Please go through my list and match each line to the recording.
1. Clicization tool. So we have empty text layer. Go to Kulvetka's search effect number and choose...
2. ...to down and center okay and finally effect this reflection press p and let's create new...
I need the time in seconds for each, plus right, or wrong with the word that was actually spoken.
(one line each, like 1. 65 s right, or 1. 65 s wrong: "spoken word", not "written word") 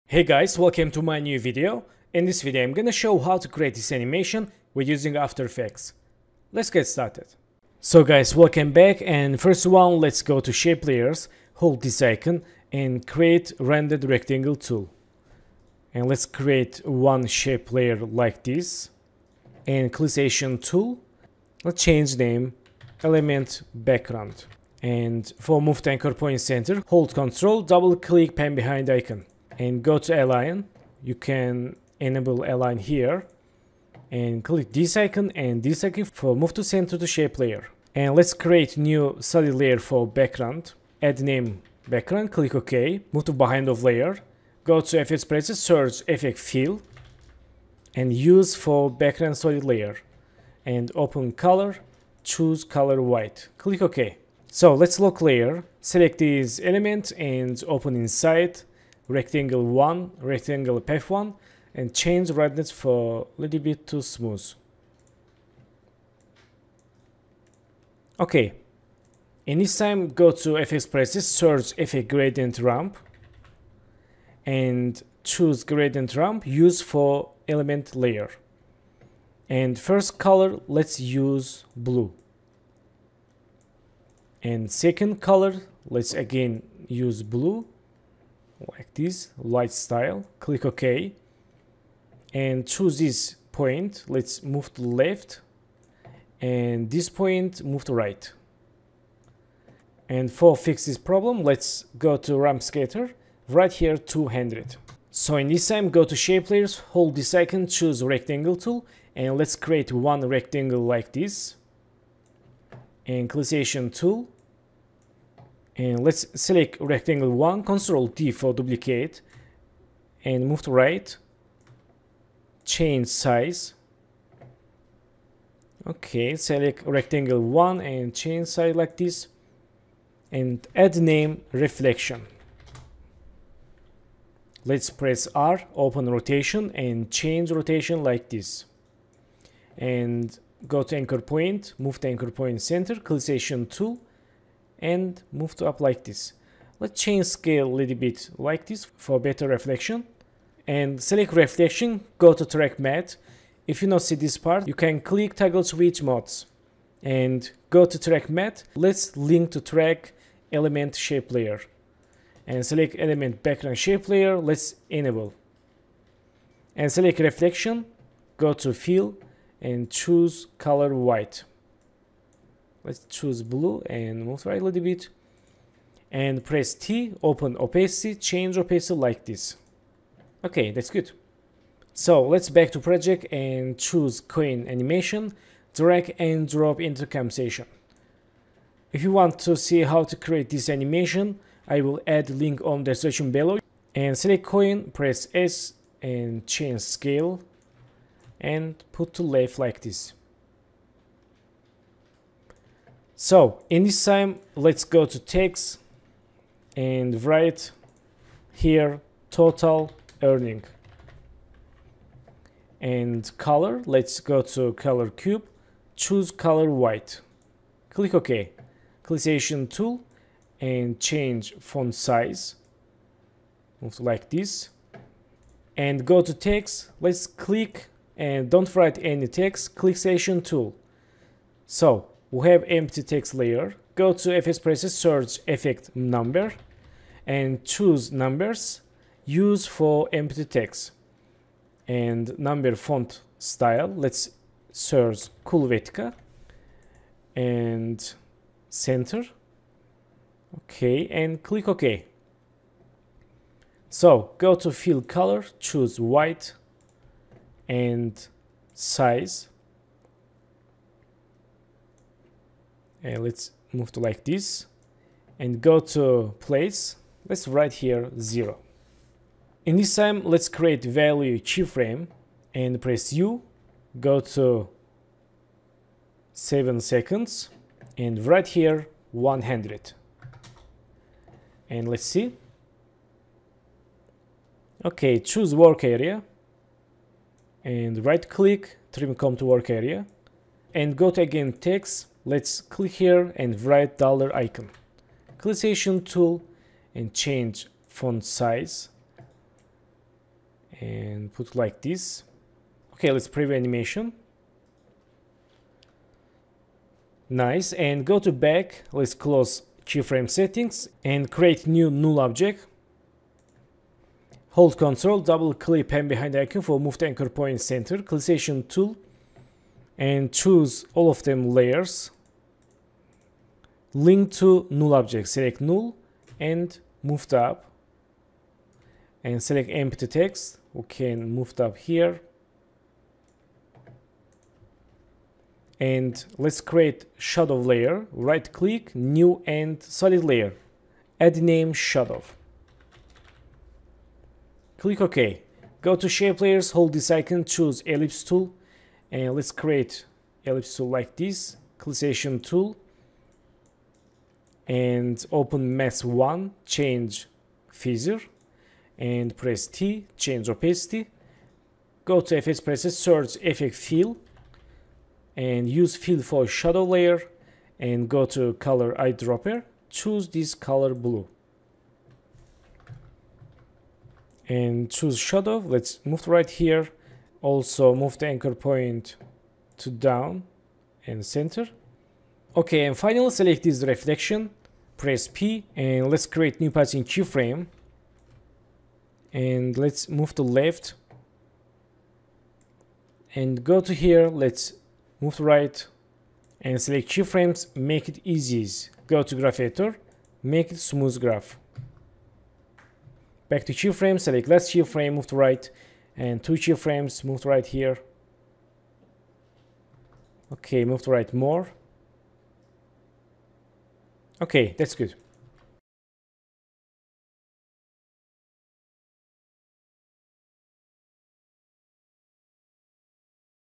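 1. 229 s wrong: "FSPress", not "Kulvetka"
2. 379 s wrong: "select", not "effect".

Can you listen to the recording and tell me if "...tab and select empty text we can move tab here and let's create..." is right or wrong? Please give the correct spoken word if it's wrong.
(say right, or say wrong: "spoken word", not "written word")
right.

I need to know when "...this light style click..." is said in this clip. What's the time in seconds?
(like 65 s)
88 s.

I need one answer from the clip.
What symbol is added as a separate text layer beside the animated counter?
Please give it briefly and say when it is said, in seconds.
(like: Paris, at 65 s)
Dollar icon, at 293 s.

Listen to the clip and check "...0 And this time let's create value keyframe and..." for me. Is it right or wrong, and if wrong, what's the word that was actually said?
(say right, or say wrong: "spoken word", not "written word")
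right.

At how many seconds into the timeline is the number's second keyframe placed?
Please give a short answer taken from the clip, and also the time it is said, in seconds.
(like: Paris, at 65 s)
7 seconds, at 276 s.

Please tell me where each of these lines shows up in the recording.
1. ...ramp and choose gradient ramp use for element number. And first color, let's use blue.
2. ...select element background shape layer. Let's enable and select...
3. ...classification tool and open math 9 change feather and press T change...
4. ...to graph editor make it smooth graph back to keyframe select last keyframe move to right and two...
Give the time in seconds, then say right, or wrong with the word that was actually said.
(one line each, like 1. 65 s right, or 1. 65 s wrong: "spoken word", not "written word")
1. 72 s wrong: "layer", not "number"
2. 162 s right
3. 351 s wrong: "1", not "9"
4. 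399 s right.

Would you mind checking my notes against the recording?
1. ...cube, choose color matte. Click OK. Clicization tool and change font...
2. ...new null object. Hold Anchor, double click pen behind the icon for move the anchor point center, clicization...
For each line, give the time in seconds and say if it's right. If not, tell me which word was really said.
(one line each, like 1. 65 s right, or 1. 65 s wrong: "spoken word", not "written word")
1. 215 s wrong: "white", not "matte"
2. 311 s wrong: "Ctrl", not "Anchor".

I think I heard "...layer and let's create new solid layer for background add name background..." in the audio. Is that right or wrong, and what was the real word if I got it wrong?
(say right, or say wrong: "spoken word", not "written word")
right.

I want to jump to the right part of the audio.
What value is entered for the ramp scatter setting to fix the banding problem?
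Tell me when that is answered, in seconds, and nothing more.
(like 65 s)
103 s.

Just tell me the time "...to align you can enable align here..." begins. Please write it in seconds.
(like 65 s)
29 s.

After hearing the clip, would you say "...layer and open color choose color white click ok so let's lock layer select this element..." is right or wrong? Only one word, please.
right.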